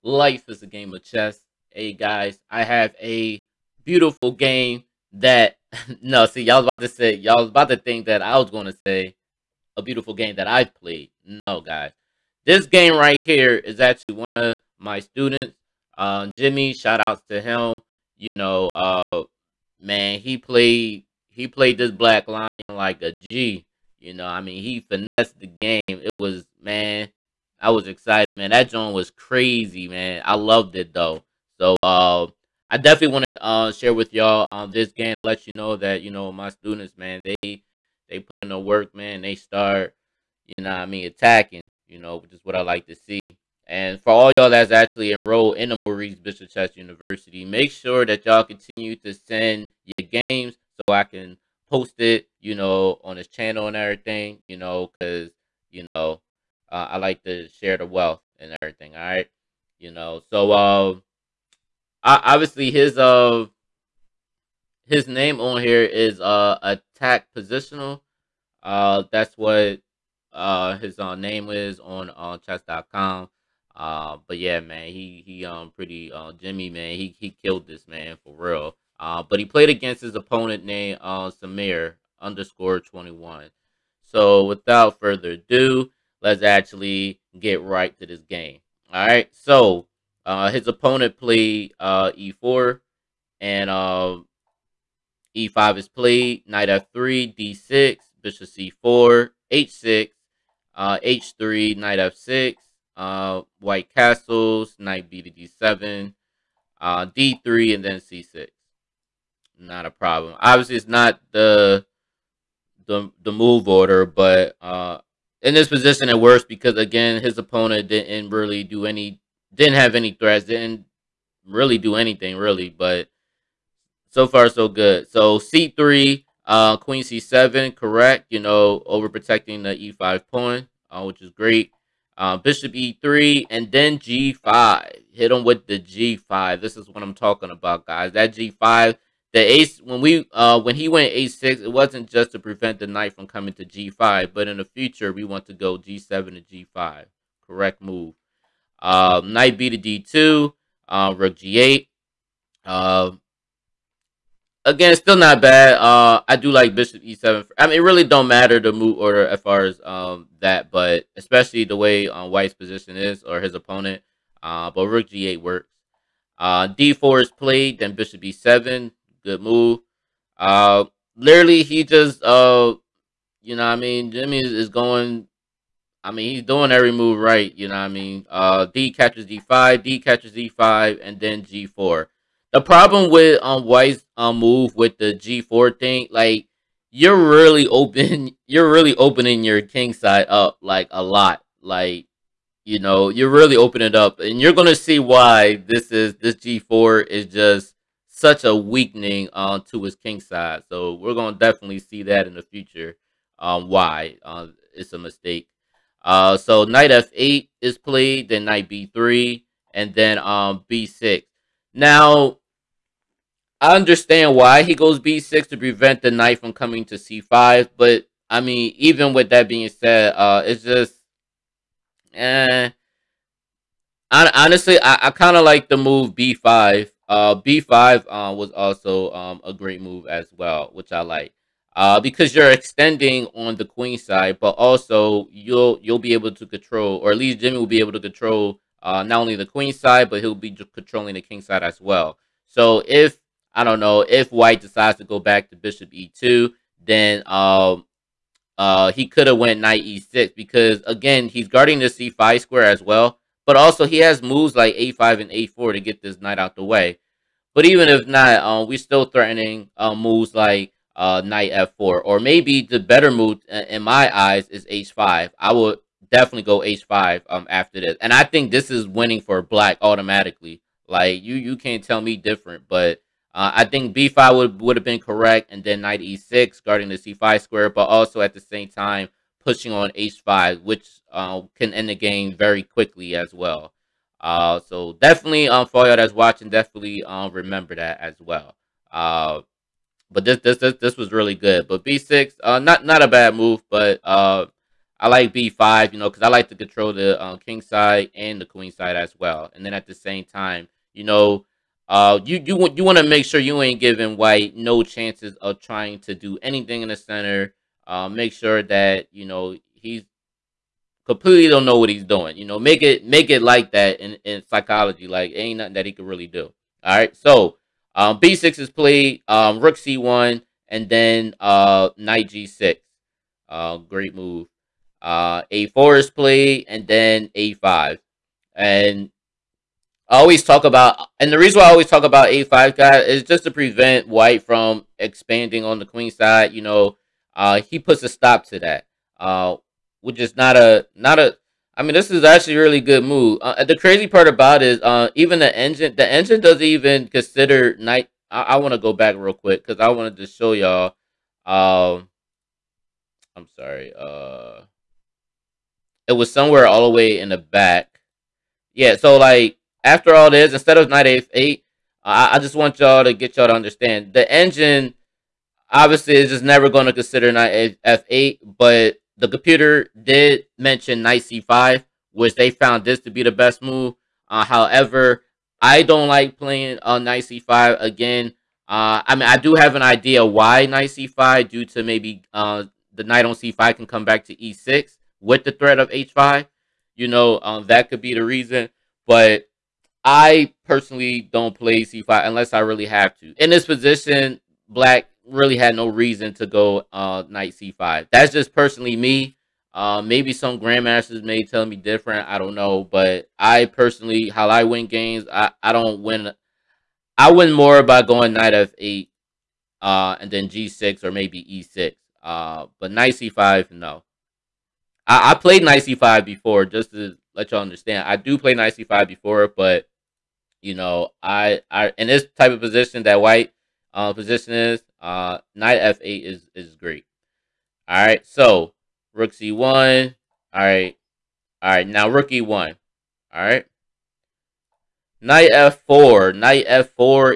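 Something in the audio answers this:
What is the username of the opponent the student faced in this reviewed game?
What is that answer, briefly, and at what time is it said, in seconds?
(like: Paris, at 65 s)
Samir_21, at 81 s.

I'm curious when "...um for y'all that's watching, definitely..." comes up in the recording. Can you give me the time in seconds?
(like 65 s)
285 s.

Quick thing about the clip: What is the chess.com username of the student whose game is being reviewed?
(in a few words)
attack positional.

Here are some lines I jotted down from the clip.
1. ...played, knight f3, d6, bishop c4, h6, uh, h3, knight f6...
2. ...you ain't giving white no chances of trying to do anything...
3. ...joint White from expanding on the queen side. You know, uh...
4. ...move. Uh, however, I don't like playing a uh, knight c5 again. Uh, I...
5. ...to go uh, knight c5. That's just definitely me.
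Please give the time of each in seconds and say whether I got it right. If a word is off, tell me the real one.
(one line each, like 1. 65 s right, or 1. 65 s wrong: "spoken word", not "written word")
1. 95 s right
2. 303 s right
3. 333 s wrong: "prevent", not "joint"
4. 373 s right
5. 396 s wrong: "personally", not "definitely".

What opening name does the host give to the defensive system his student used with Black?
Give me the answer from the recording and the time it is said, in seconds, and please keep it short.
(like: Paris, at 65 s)
Black Lion, at 21 s.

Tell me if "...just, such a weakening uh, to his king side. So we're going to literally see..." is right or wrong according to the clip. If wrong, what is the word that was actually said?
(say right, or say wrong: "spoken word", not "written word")
wrong: "definitely", not "literally".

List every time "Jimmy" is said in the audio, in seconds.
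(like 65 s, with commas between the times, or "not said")
16 s, 76 s, 174 s, 237 s.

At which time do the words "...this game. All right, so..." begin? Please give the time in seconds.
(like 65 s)
88 s.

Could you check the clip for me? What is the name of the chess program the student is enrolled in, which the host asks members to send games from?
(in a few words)
Maurice Bishop Chess University.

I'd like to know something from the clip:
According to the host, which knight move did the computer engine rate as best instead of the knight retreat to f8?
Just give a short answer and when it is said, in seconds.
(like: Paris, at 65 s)
knight c5, at 369 s.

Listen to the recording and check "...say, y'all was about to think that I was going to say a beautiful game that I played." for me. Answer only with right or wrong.
right.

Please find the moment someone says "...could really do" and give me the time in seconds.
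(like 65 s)
315 s.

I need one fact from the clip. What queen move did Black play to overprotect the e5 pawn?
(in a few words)
Queen c7.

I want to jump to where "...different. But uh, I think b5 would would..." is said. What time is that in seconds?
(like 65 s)
272 s.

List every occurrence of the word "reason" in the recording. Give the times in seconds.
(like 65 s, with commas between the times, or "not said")
331 s, 388 s, 395 s.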